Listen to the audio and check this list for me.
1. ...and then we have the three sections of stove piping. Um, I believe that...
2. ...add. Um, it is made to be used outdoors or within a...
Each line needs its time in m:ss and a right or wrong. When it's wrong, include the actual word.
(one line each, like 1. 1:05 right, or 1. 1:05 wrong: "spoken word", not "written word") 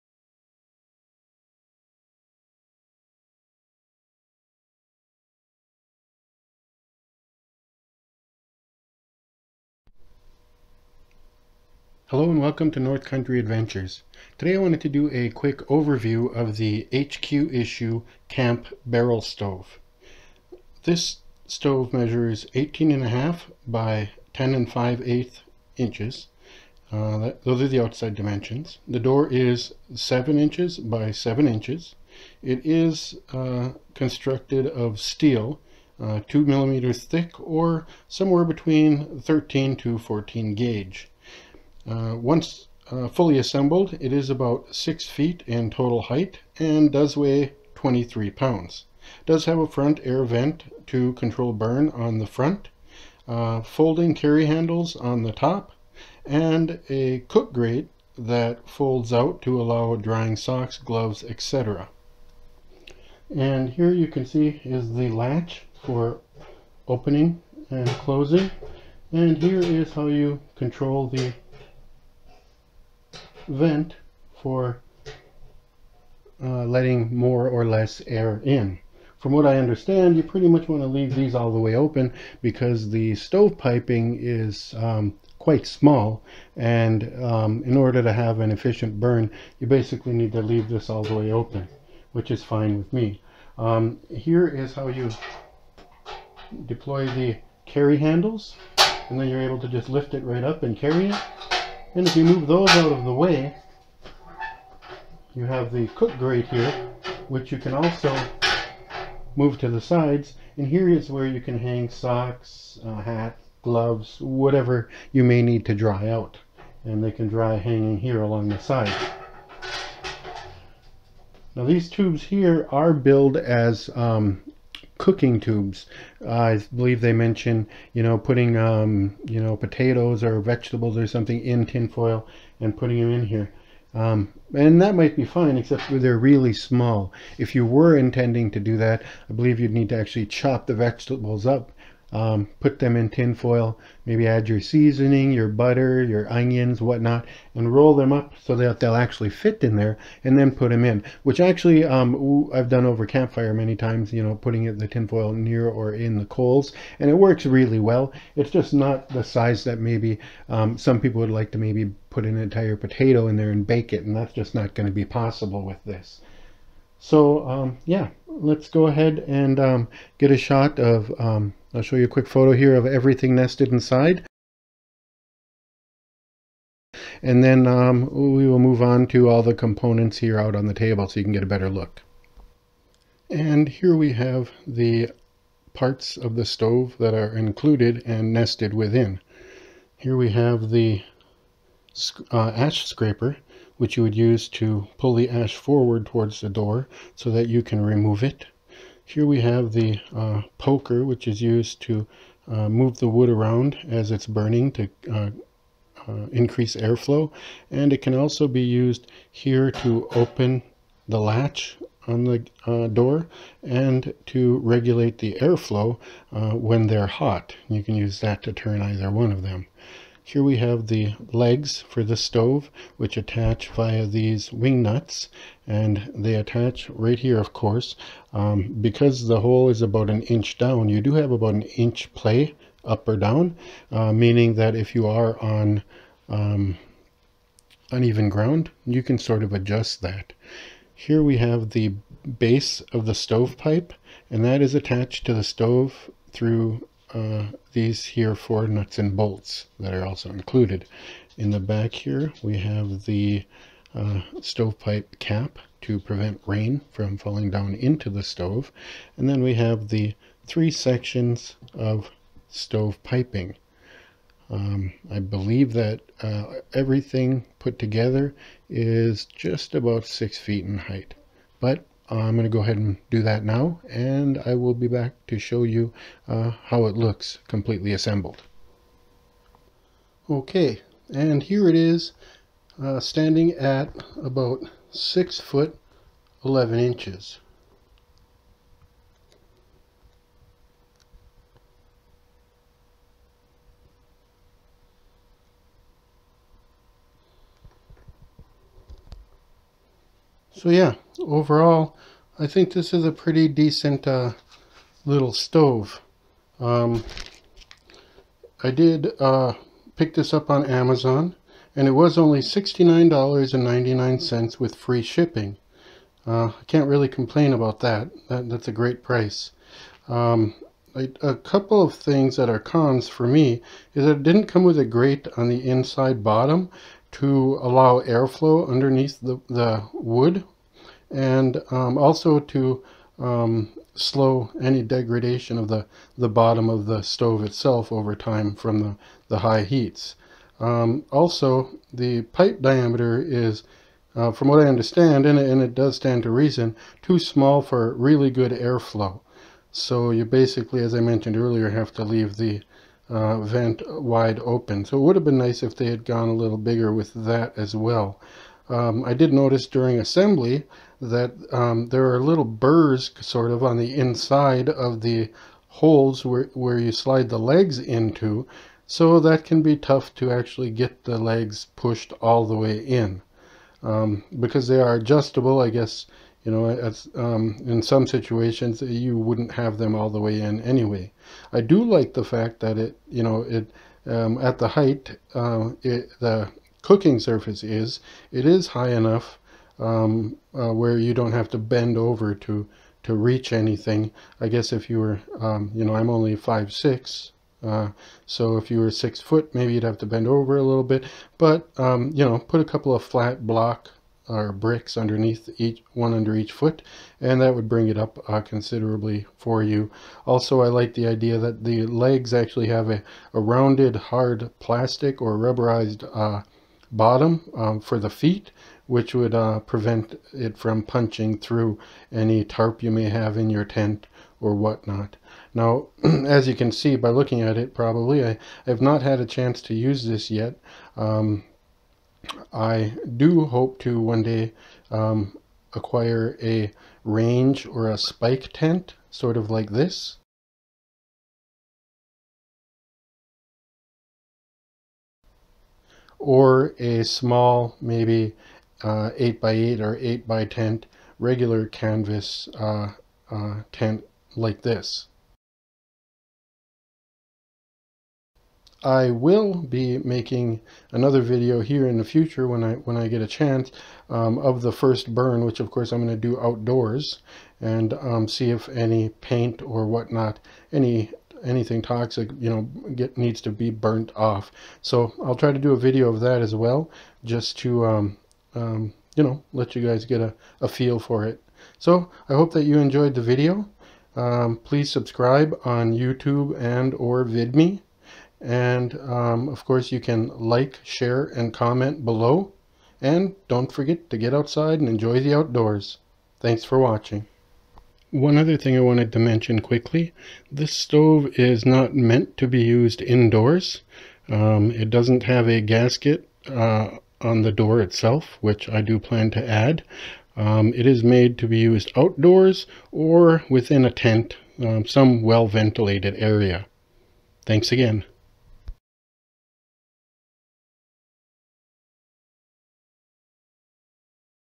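1. 4:19 right
2. 8:29 right.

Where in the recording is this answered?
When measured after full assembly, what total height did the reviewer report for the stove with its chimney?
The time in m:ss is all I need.
4:44.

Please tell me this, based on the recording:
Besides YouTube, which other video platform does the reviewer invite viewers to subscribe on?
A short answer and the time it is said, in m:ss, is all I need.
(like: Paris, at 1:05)
VidMe, at 8:07.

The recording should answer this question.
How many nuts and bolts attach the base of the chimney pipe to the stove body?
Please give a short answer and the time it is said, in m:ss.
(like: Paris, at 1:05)
4, at 4:08.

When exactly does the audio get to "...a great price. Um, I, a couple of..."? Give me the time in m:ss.
5:18.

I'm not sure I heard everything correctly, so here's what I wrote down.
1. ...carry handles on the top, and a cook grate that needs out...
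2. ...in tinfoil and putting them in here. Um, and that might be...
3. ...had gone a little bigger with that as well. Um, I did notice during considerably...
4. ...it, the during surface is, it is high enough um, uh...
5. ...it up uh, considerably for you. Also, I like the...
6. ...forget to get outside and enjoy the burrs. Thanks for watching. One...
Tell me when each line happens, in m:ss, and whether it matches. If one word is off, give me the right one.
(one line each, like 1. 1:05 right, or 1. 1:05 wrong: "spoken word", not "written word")
1. 0:54 wrong: "folds", not "needs"
2. 2:11 right
3. 5:55 wrong: "assembly", not "considerably"
4. 6:25 wrong: "cooking", not "during"
5. 6:47 right
6. 8:13 wrong: "outdoors", not "burrs".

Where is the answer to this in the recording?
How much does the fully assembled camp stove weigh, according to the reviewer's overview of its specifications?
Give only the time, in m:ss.
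0:47.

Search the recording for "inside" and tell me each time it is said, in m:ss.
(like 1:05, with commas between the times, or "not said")
2:53, 5:25, 6:03.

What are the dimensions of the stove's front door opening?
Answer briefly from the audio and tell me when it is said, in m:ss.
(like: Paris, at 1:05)
7 by 7 inches, at 0:29.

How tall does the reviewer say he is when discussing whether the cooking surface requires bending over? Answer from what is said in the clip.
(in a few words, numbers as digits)
5 foot 6.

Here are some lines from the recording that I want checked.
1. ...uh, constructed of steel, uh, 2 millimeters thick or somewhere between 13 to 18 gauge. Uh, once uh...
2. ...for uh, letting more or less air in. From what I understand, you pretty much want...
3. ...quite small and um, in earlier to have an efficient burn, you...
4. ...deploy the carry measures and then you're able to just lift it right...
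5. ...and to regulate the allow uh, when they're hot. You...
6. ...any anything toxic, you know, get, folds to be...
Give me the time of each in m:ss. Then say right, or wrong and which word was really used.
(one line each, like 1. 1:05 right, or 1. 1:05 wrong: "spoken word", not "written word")
1. 0:33 wrong: "14", not "18"
2. 1:14 right
3. 1:25 wrong: "order", not "earlier"
4. 1:36 wrong: "handles", not "measures"
5. 3:33 wrong: "airflow", not "allow"
6. 7:50 wrong: "needs", not "folds".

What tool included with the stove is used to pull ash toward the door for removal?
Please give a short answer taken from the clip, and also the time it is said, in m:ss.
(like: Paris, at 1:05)
Ash scraper, at 3:12.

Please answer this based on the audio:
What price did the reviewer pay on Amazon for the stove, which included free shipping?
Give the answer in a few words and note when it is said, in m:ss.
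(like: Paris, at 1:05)
$69.99, at 5:12.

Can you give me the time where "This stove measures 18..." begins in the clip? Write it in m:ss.
0:20.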